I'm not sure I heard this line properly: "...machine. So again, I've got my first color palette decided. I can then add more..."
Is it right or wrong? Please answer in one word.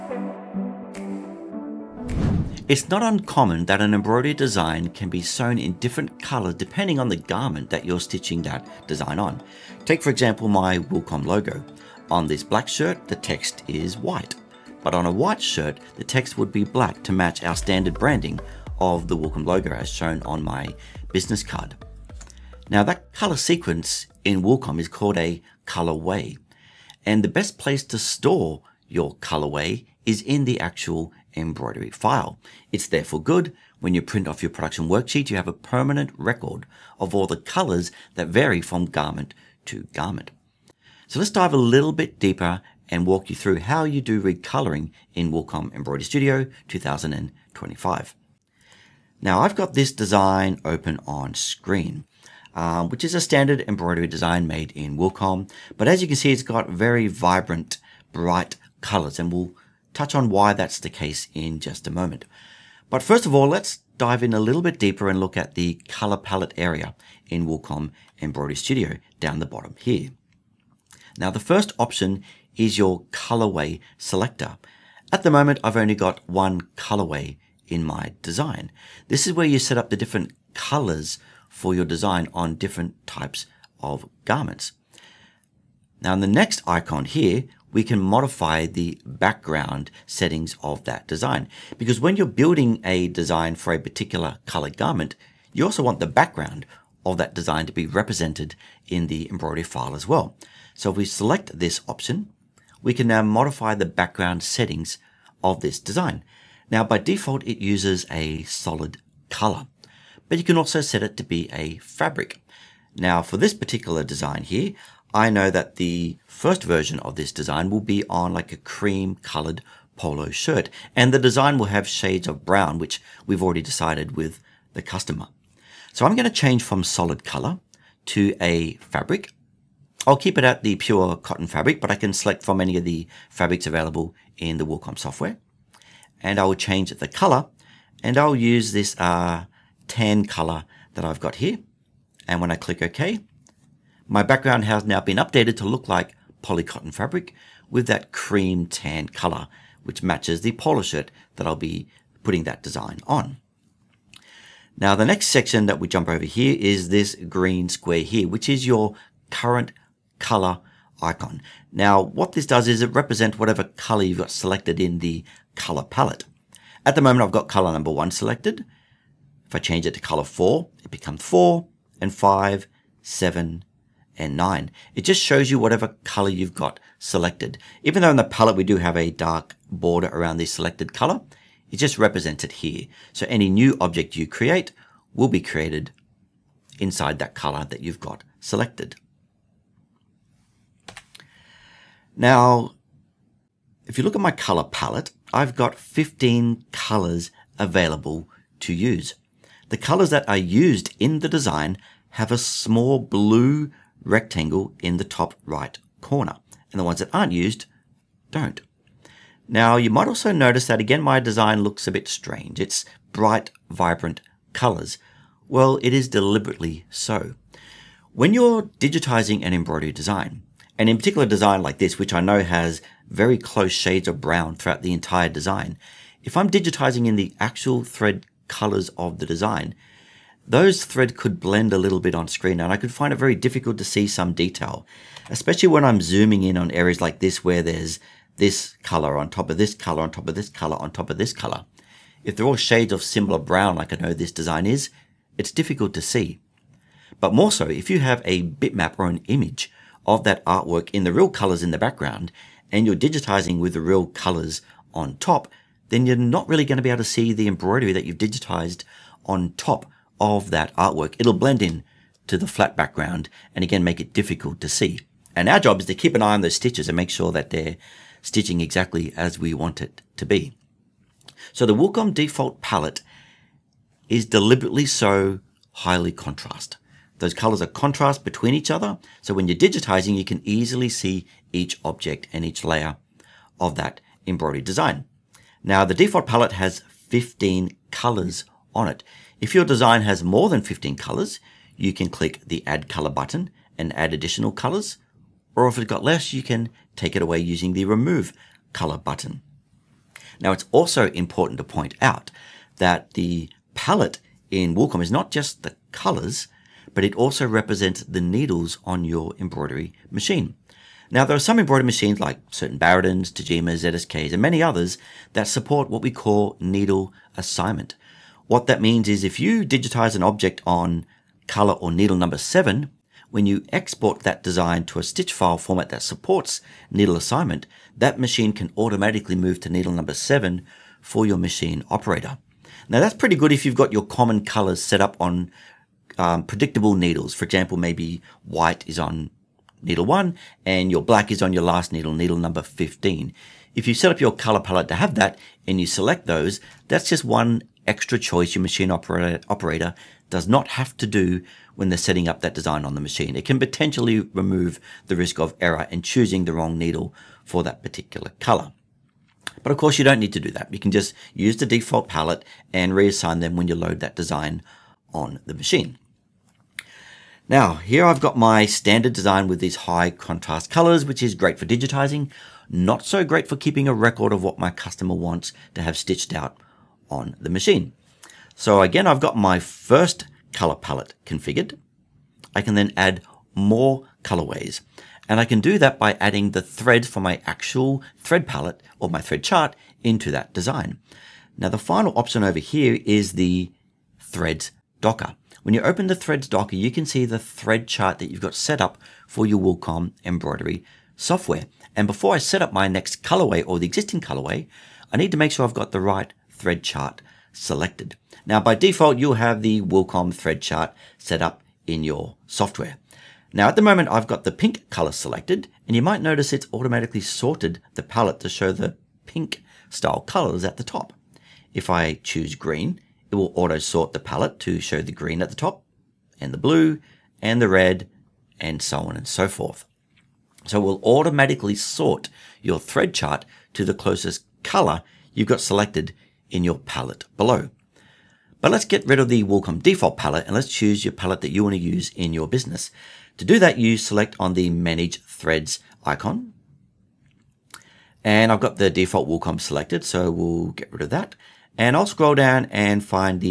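wrong.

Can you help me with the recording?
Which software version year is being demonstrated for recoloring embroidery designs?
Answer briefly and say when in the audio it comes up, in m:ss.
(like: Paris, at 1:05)
2025, at 0:46.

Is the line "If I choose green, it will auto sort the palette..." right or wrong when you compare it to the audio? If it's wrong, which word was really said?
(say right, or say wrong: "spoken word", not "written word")
right.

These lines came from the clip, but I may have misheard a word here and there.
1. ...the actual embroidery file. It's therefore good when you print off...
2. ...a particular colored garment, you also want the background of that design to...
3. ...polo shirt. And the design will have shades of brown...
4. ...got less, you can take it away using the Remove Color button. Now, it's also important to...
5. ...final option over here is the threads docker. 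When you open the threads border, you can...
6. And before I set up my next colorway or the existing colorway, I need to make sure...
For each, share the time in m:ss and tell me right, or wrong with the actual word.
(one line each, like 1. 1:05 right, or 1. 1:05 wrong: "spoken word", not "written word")
1. 0:30 right
2. 1:33 right
3. 1:59 right
4. 4:55 right
5. 6:31 wrong: "docker", not "border"
6. 6:41 right.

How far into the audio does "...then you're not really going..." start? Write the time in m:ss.
4:15.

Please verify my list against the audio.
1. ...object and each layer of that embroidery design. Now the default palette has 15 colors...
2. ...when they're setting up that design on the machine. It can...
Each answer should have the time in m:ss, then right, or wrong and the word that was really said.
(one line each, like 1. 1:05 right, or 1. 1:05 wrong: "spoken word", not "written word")
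1. 4:41 right
2. 5:51 right.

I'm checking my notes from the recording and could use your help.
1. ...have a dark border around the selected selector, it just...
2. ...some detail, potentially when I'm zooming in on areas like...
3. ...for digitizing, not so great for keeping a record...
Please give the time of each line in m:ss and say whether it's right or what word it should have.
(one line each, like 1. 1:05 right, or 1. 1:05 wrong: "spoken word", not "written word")
1. 2:58 wrong: "color", not "selector"
2. 3:54 wrong: "especially", not "potentially"
3. 6:11 right.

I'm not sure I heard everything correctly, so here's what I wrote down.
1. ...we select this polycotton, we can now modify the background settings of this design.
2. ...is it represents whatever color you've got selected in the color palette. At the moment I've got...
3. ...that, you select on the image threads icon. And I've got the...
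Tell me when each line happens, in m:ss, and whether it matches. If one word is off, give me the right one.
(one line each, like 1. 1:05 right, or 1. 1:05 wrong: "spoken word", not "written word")
1. 1:40 wrong: "option", not "polycotton"
2. 2:42 right
3. 7:23 wrong: "manage", not "image".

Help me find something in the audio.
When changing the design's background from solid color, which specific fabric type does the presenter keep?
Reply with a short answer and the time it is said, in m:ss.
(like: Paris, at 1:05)
Pure cotton, at 2:10.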